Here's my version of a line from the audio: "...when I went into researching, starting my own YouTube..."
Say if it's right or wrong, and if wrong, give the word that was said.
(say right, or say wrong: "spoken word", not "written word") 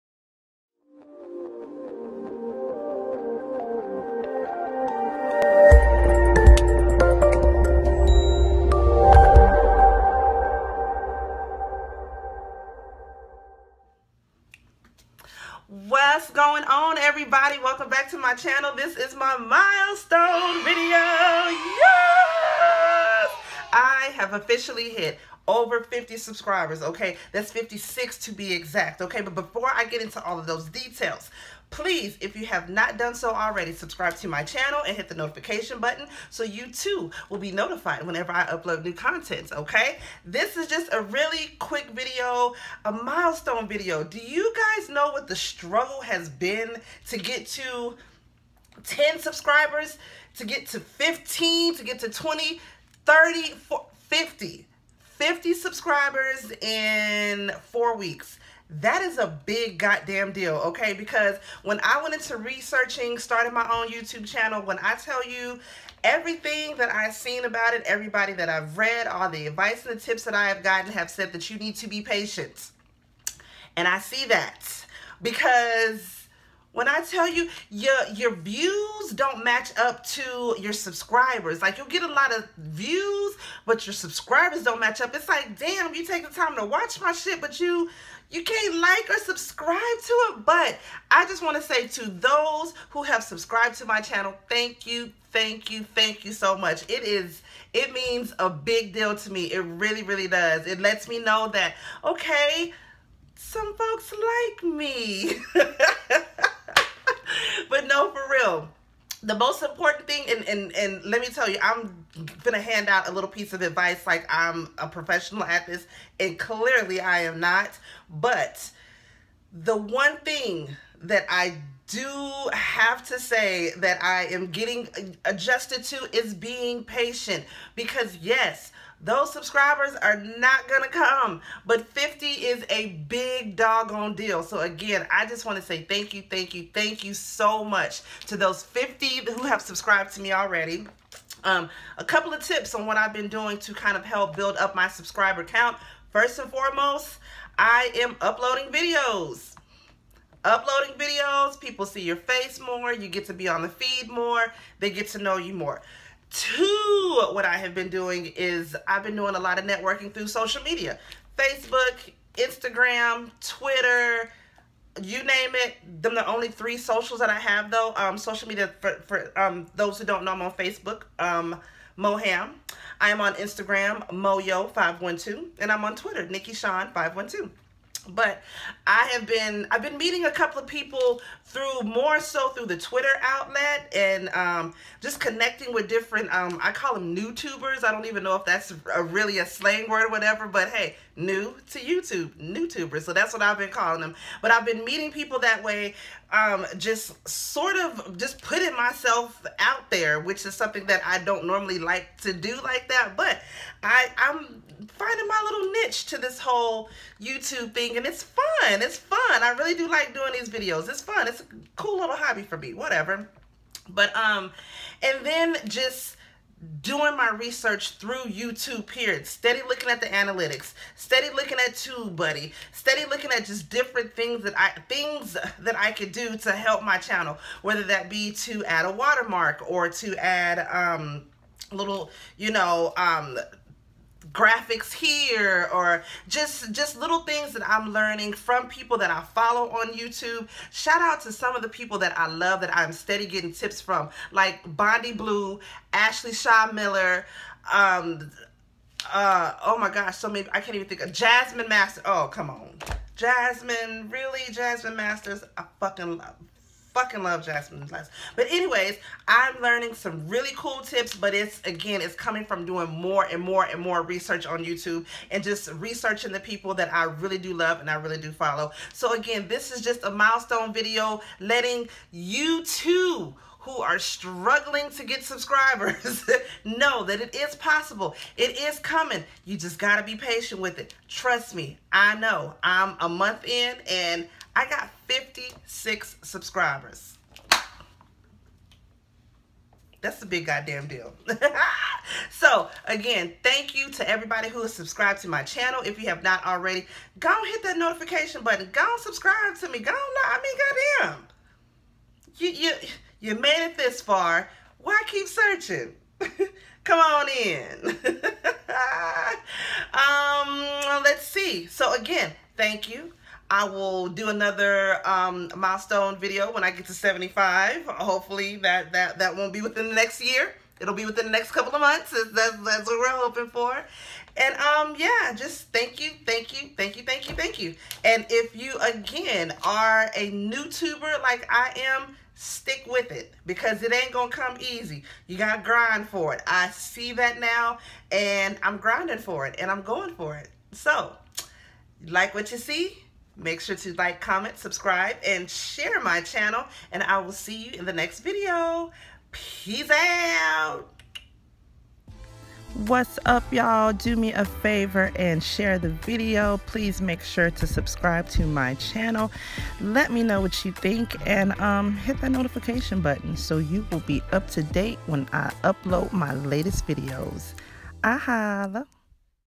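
right.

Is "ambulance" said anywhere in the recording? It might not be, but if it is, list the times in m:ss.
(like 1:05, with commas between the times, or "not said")
not said.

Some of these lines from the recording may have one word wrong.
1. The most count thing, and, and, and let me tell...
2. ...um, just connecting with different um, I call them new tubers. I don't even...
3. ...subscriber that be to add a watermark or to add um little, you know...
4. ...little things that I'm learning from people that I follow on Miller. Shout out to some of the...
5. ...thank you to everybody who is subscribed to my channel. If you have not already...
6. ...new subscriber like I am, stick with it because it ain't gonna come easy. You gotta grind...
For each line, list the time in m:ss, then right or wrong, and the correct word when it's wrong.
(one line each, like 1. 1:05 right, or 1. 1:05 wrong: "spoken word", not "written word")
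1. 1:49 wrong: "important", not "count"
2. 3:04 right
3. 3:47 wrong: "whether", not "subscriber"
4. 3:56 wrong: "YouTube", not "Miller"
5. 4:53 right
6. 5:30 wrong: "tuber", not "subscriber".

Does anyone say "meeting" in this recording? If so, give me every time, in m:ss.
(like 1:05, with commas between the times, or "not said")
2:59, 3:14.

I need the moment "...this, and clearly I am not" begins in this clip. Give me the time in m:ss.
1:55.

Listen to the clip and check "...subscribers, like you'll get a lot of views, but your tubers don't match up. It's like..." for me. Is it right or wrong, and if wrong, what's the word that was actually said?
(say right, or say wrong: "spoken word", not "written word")
wrong: "subscribers", not "tubers".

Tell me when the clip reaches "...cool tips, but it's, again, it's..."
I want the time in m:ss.
4:20.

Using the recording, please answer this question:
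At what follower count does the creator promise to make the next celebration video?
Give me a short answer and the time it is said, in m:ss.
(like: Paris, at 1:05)
75, at 5:16.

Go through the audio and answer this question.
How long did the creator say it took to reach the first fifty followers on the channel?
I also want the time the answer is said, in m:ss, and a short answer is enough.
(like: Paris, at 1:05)
four weeks, at 0:57.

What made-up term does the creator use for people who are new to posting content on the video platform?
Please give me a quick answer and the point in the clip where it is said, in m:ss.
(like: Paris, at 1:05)
newtubers, at 3:12.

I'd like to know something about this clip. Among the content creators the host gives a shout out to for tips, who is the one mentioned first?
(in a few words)
Bondi Blue.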